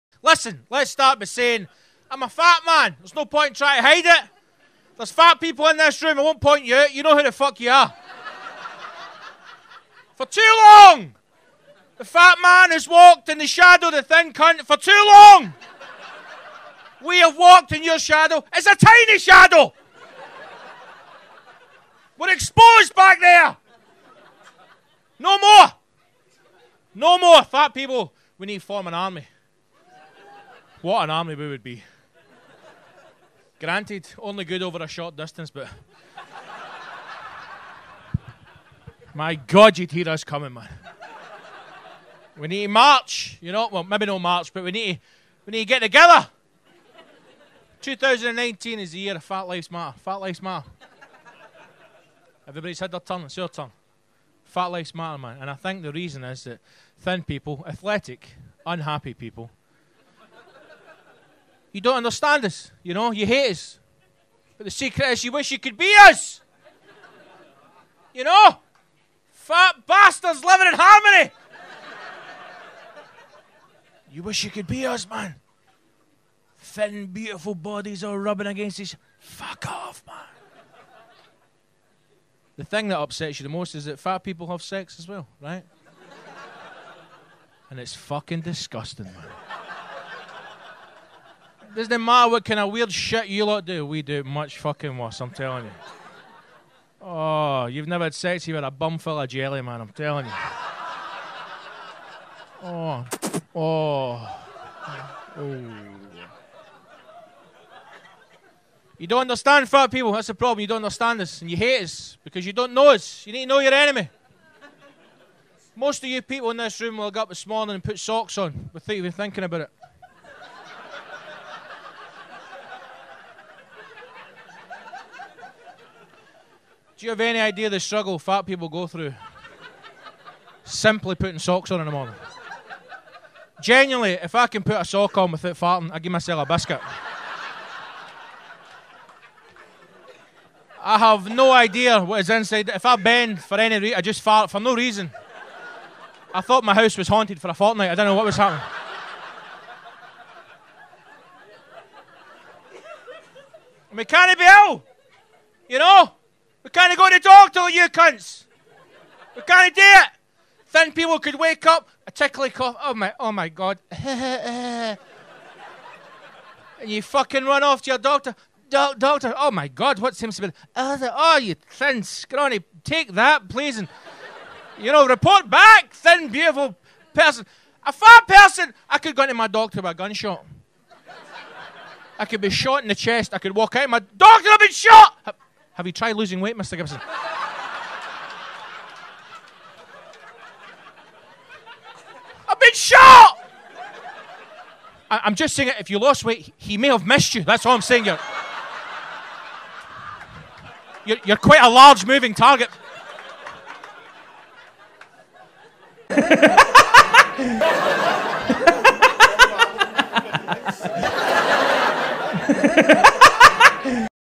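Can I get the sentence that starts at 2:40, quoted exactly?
Then people could wake up, a tickly cough.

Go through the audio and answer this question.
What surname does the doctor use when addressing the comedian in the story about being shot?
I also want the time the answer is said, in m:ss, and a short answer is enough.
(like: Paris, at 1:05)
Gibson, at 3:06.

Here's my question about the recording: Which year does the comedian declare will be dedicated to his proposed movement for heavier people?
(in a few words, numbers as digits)
2019.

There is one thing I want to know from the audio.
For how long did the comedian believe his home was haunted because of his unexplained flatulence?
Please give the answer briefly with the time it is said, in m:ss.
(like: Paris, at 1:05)
A fortnight, at 2:27.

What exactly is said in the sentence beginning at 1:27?
and it's fucking disgusting, man doesn't matter what kind of weird shit you lot do.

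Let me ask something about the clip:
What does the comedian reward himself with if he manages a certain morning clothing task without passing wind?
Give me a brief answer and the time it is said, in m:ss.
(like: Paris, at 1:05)
A biscuit, at 2:16.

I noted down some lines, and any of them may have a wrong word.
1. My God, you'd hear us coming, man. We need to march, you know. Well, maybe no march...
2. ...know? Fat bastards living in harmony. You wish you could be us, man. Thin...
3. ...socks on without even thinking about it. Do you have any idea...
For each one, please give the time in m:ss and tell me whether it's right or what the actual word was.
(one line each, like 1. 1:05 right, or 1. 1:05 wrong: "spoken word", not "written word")
1. 0:39 right
2. 1:08 right
3. 1:57 right.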